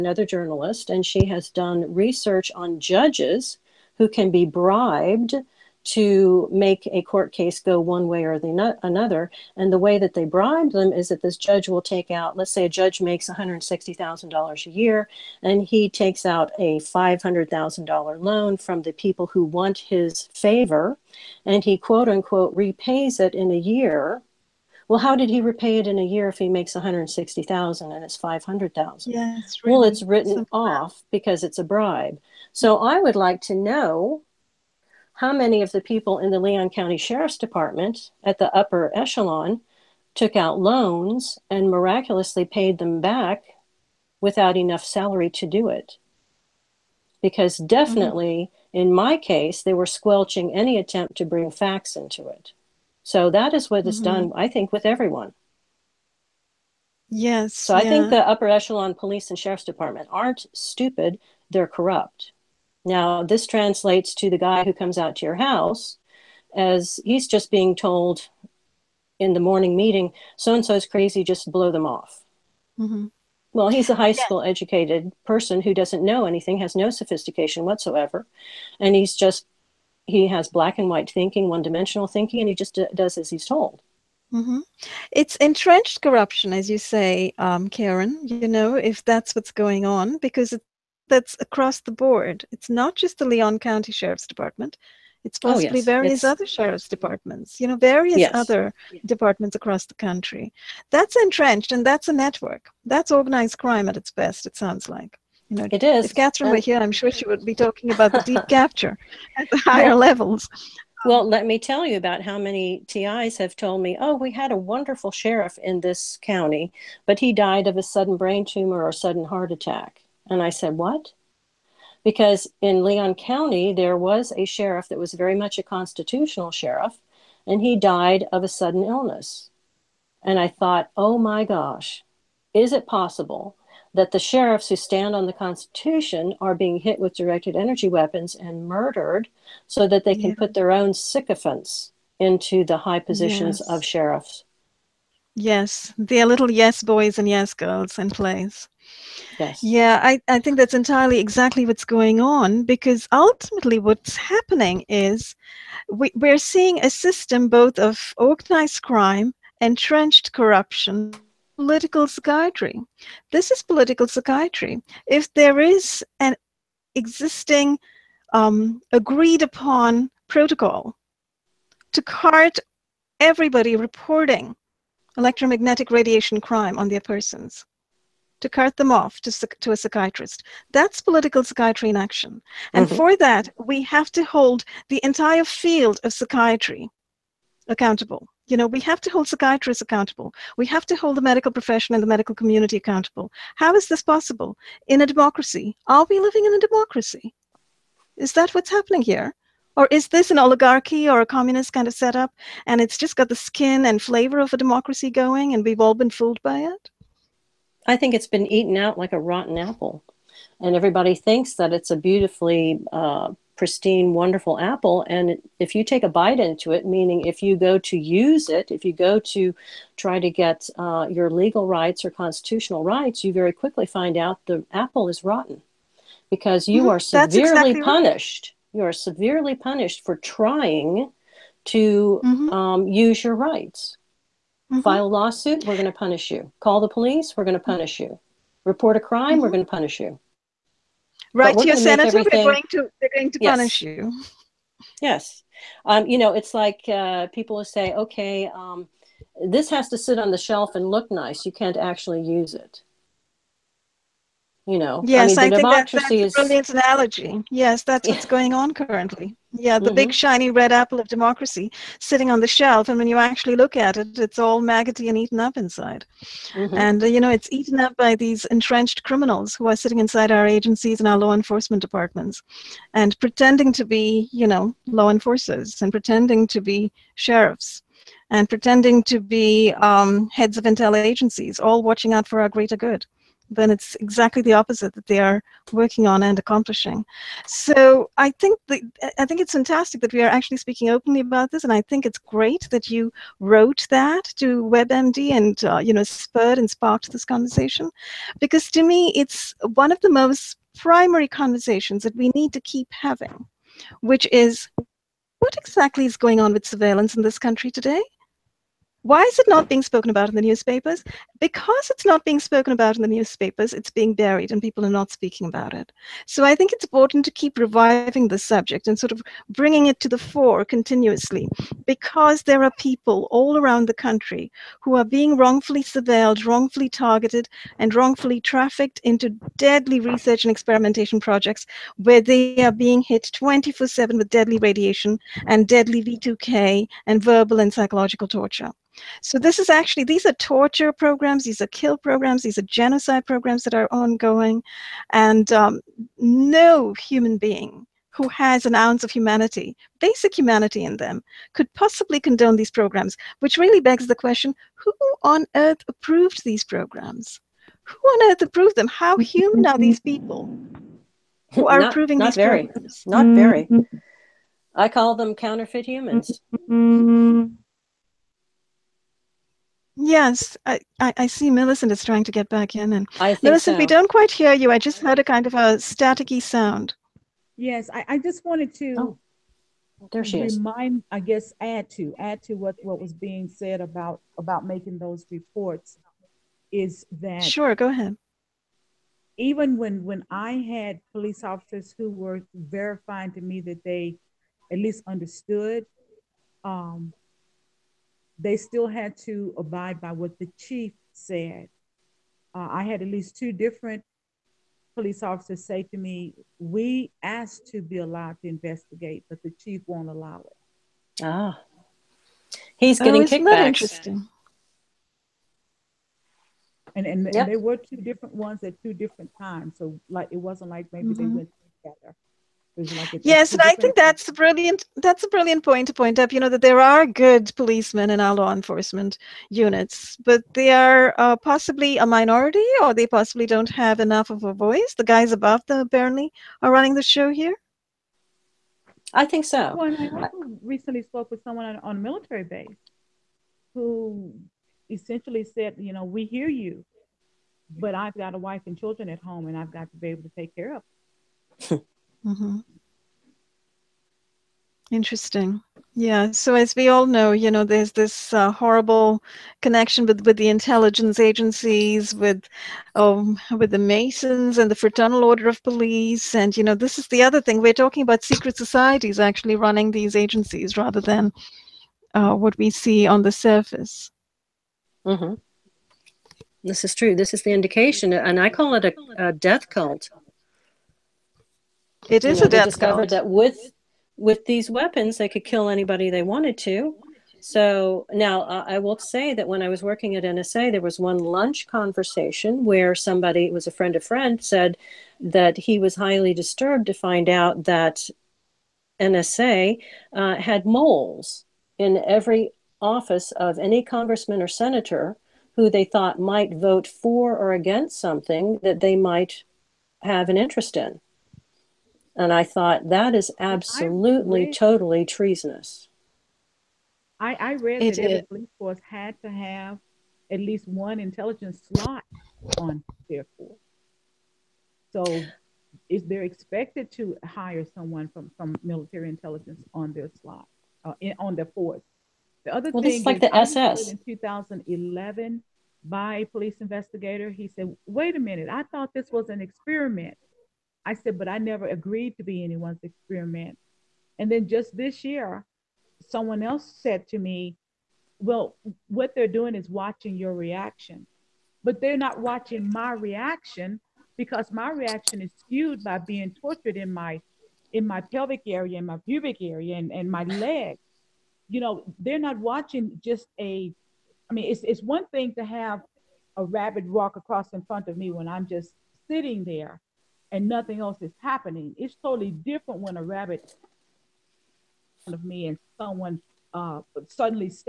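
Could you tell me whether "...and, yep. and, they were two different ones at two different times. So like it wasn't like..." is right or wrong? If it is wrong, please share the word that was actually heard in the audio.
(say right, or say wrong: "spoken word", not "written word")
right.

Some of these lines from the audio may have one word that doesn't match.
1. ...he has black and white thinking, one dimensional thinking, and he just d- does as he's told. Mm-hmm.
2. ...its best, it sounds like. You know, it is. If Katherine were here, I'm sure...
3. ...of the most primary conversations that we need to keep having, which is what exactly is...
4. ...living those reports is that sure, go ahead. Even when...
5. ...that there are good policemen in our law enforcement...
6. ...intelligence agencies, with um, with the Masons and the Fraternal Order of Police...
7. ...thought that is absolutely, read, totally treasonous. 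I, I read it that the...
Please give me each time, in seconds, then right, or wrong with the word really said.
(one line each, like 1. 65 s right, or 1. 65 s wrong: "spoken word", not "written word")
1. 80 s right
2. 103 s right
3. 299 s right
4. 384 s wrong: "making", not "living"
5. 426 s right
6. 460 s right
7. 512 s right.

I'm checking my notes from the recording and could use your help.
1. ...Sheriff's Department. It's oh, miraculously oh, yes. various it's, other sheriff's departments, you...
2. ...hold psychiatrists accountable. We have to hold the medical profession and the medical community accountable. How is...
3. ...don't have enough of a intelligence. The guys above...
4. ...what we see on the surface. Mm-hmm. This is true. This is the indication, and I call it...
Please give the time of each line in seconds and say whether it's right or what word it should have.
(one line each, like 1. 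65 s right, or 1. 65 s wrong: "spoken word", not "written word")
1. 93 s wrong: "possibly", not "miraculously"
2. 189 s right
3. 433 s wrong: "voice", not "intelligence"
4. 472 s right.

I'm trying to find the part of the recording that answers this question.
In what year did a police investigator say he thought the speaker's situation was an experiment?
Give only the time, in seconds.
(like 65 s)
534 s.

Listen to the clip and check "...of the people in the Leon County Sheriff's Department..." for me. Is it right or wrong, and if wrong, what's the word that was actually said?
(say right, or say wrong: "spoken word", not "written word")
right.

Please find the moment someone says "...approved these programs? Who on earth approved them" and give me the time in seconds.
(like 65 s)
355 s.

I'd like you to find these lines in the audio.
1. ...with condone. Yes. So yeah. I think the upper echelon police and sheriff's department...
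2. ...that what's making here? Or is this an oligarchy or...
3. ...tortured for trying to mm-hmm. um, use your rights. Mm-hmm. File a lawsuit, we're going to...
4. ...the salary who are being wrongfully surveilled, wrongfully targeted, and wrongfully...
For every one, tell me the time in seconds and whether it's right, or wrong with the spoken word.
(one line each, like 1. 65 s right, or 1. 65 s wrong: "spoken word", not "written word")
1. 54 s wrong: "everyone", not "condone"
2. 198 s wrong: "happening", not "making"
3. 229 s wrong: "punished", not "tortured"
4. 323 s wrong: "country", not "salary".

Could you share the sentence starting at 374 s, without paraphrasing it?
I just heard a kind of a staticky sound.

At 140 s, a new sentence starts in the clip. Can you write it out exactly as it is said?
put their own sycophants into the high positions yes.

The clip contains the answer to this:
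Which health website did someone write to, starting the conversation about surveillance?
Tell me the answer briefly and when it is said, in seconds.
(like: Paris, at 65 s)
WebMD, at 294 s.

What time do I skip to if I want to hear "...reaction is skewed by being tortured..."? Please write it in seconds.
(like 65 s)
554 s.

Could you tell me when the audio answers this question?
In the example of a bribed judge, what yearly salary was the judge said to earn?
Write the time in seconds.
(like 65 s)
13 s.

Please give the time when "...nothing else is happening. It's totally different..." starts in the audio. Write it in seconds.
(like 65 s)
570 s.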